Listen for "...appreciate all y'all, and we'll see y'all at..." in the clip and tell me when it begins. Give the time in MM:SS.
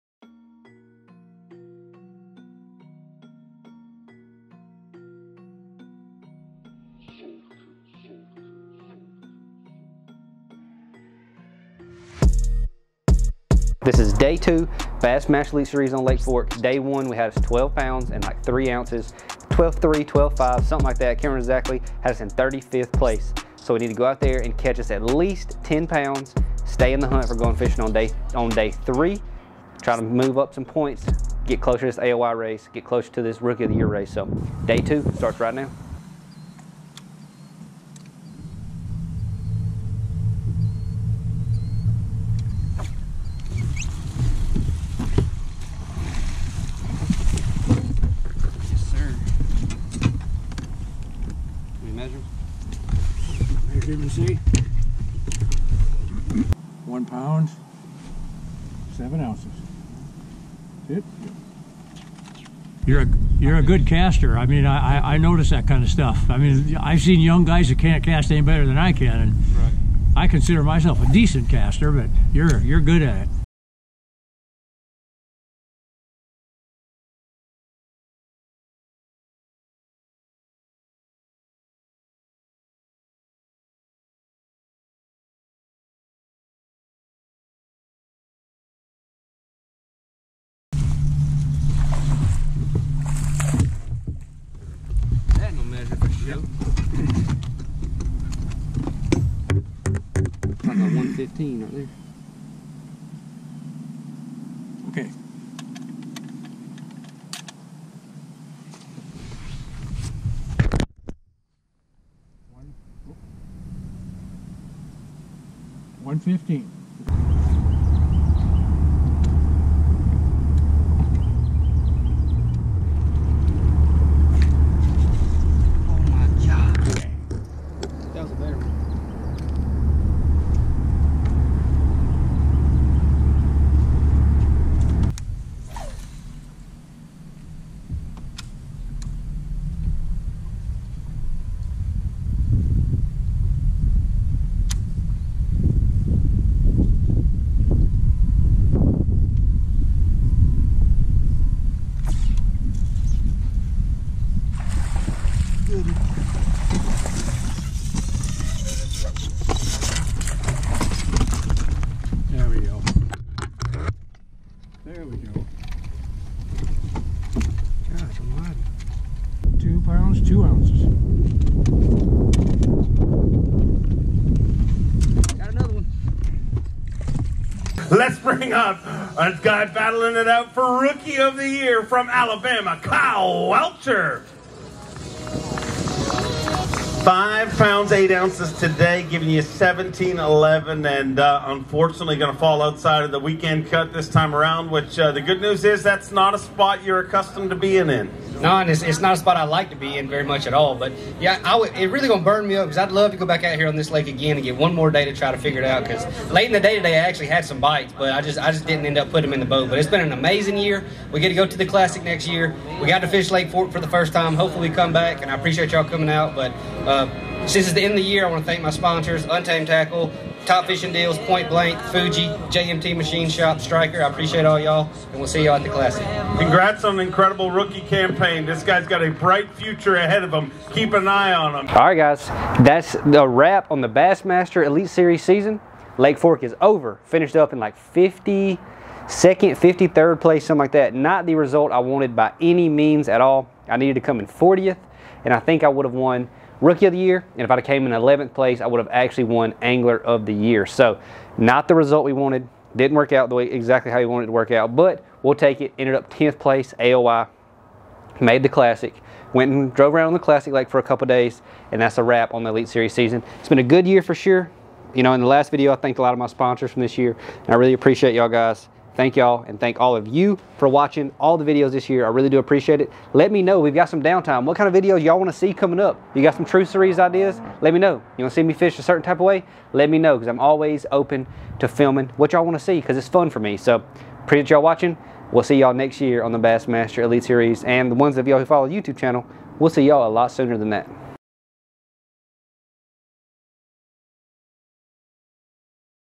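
03:44.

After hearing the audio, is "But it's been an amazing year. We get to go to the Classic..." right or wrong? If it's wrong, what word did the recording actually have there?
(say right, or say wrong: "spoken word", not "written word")
right.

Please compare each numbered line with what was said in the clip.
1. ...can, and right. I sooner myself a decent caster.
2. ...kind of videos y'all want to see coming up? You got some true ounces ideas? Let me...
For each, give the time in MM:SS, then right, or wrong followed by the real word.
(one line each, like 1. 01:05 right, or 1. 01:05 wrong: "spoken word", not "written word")
1. 01:08 wrong: "consider", not "sooner"
2. 04:34 wrong: "series", not "ounces".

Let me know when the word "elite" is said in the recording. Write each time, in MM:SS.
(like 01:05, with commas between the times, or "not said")
00:15, 03:54, 04:22, 04:47.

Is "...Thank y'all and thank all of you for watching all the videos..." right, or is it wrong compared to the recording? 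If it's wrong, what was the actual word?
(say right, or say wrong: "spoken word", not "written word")
right.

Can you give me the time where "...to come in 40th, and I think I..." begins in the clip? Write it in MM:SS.
04:03.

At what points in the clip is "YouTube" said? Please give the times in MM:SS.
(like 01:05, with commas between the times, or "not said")
04:48.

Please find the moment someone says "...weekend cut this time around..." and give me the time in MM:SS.
03:13.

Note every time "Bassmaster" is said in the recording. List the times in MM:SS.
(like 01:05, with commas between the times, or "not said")
00:14, 03:53, 04:46.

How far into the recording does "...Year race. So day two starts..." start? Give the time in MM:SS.
00:33.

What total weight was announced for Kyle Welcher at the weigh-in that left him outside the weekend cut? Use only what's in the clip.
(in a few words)
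17.11.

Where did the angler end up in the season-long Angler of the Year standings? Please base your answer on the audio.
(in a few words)
10th place.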